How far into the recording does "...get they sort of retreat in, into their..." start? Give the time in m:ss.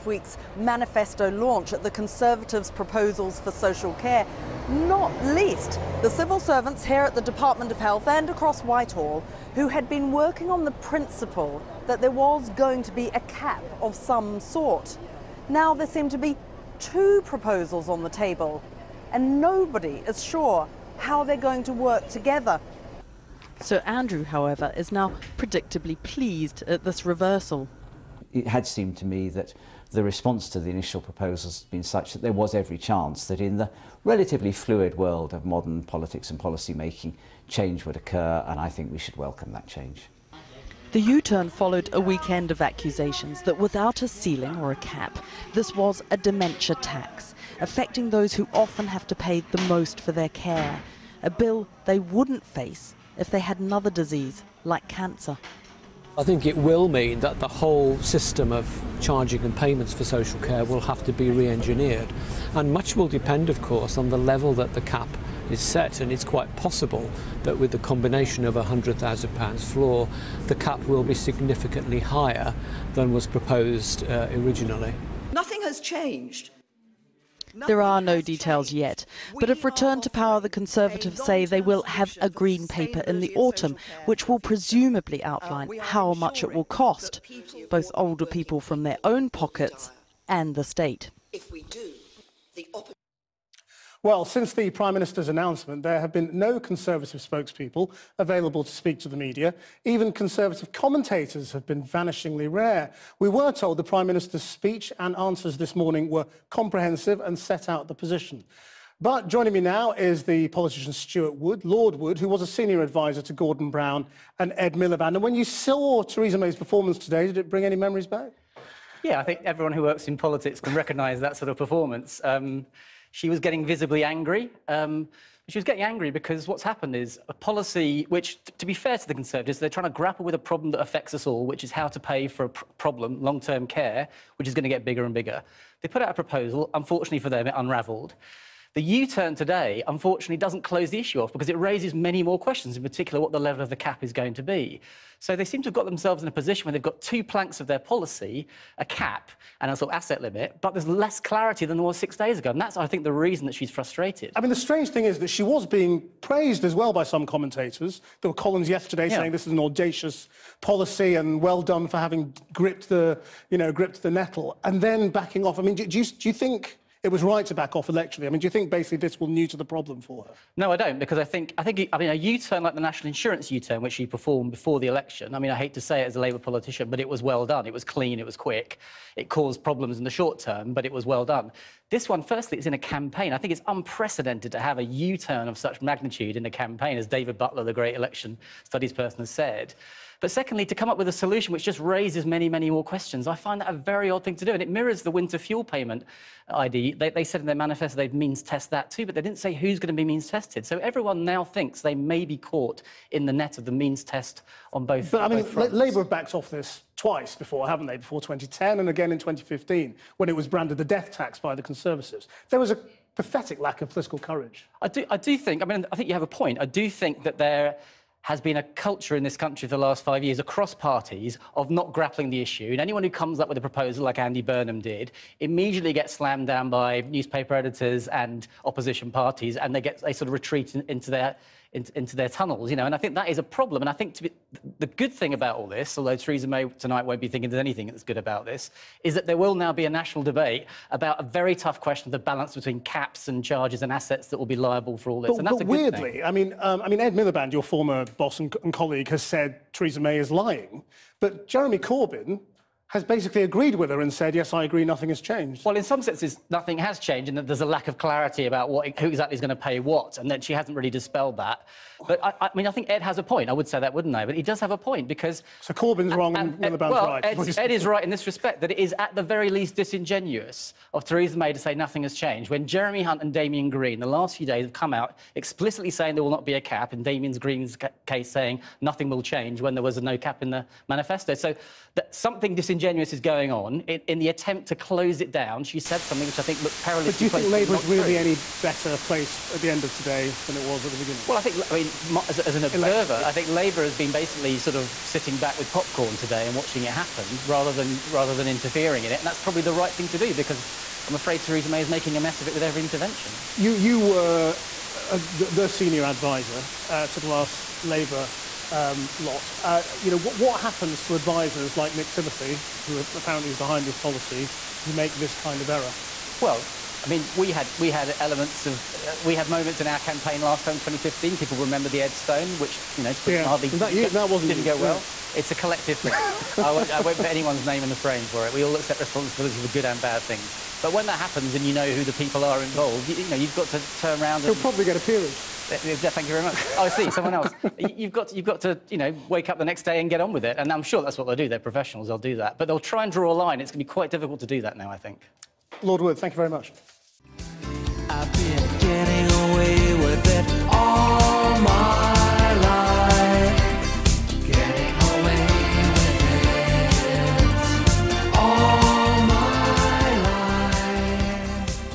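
3:49.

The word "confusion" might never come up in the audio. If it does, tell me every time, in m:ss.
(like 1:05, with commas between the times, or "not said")
not said.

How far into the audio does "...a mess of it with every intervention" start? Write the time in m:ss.
5:02.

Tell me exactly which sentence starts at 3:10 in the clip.
But secondly, to come up with a solution which just raises many, many more questions.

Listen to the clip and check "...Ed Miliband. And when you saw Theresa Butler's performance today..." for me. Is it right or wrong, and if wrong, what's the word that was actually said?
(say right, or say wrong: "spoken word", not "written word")
wrong: "May", not "Butler".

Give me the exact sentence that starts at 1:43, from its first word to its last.
We were told the Prime Minister's speech and answers this morning were comprehensive and set out the position.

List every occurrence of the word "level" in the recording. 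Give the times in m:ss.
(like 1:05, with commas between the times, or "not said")
1:04, 2:23.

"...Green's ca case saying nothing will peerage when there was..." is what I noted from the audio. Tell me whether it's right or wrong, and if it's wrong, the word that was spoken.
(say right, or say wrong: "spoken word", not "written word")
wrong: "change", not "peerage".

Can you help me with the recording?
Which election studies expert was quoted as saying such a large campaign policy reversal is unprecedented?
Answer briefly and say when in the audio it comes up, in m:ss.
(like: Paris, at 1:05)
David Butler, at 3:07.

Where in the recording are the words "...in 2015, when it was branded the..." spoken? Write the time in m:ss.
3:29.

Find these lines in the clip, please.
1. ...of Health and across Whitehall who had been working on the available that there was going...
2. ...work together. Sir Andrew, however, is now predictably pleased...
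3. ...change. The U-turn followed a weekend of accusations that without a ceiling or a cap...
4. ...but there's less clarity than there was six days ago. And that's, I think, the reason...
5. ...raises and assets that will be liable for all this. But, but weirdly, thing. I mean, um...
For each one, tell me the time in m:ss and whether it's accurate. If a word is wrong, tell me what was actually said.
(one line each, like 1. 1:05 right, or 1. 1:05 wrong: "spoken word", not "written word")
1. 0:07 wrong: "principle", not "available"
2. 0:21 right
3. 0:39 right
4. 2:30 right
5. 4:03 wrong: "charges", not "raises".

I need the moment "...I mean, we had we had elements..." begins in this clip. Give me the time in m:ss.
5:17.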